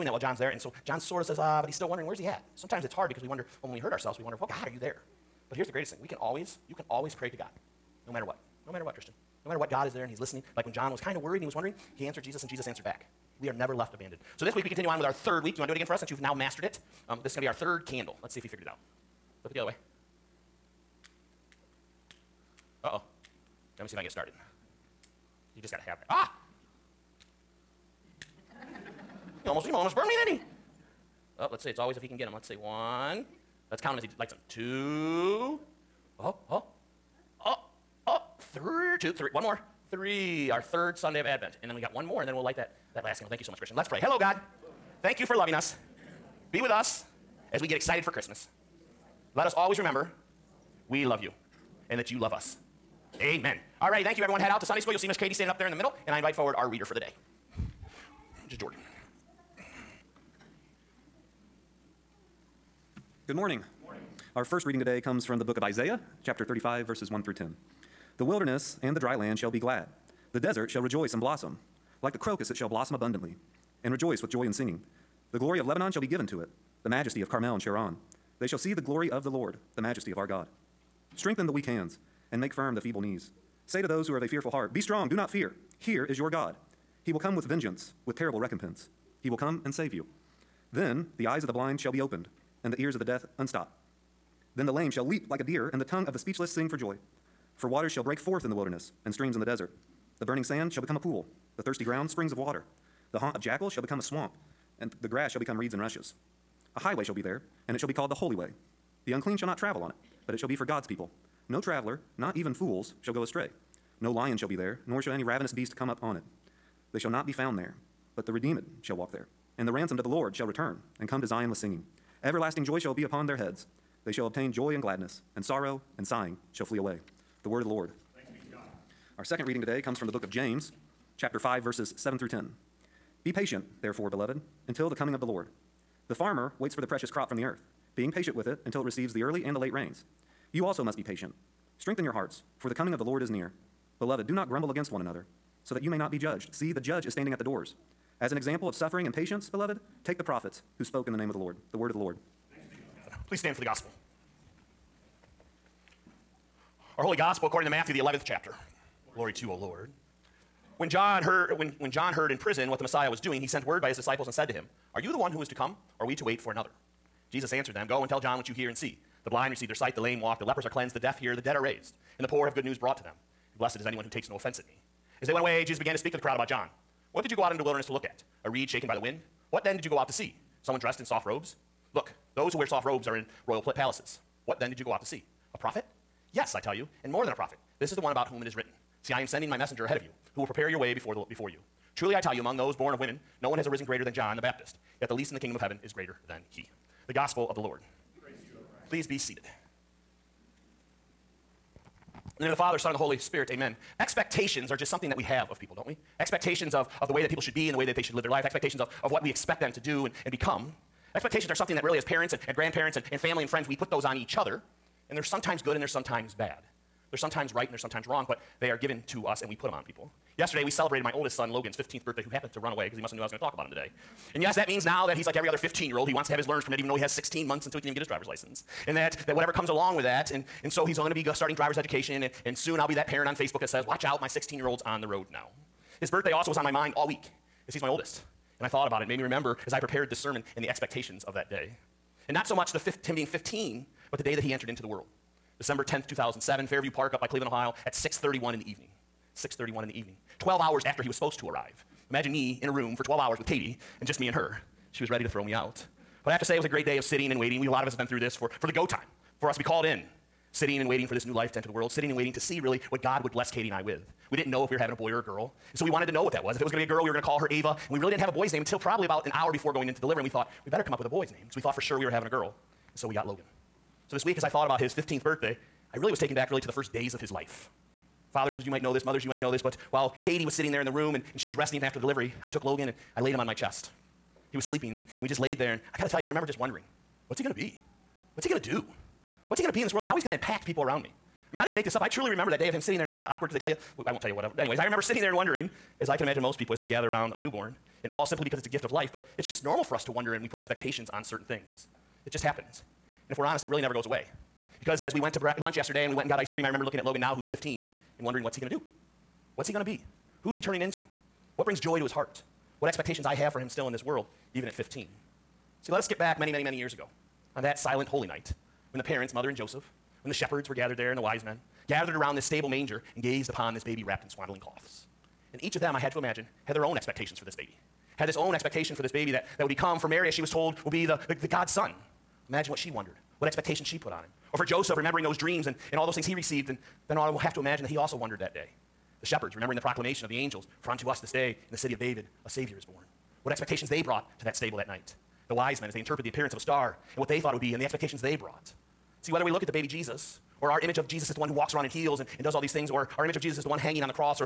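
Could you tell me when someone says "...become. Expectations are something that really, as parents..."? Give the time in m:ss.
3:30.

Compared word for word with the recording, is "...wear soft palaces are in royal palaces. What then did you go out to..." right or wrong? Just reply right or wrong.
wrong.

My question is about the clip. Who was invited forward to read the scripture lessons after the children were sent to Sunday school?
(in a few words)
Jordan.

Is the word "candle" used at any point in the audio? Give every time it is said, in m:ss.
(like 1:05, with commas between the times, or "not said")
0:17, 0:43.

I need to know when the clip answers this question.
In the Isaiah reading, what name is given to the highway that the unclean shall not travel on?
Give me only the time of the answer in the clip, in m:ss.
1:48.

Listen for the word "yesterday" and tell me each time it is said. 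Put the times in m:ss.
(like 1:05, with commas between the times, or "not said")
3:40, 5:05.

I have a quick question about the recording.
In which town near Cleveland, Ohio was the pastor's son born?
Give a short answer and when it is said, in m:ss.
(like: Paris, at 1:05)
Fairview Park, at 4:06.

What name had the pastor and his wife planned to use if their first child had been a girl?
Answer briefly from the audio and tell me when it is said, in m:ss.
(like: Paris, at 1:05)
Ava, at 4:27.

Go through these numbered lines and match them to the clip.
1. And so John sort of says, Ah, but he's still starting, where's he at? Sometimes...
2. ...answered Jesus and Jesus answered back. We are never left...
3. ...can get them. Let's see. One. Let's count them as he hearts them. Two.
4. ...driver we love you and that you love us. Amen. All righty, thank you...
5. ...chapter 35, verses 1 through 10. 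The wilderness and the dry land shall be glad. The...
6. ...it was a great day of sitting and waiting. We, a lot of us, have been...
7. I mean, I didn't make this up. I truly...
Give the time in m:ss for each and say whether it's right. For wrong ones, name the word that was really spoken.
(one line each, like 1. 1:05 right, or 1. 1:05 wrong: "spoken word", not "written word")
1. 0:00 wrong: "wondering", not "starting"
2. 0:12 right
3. 0:32 wrong: "lights", not "hearts"
4. 0:49 wrong: "remember", not "driver"
5. 1:06 right
6. 4:16 right
7. 4:51 right.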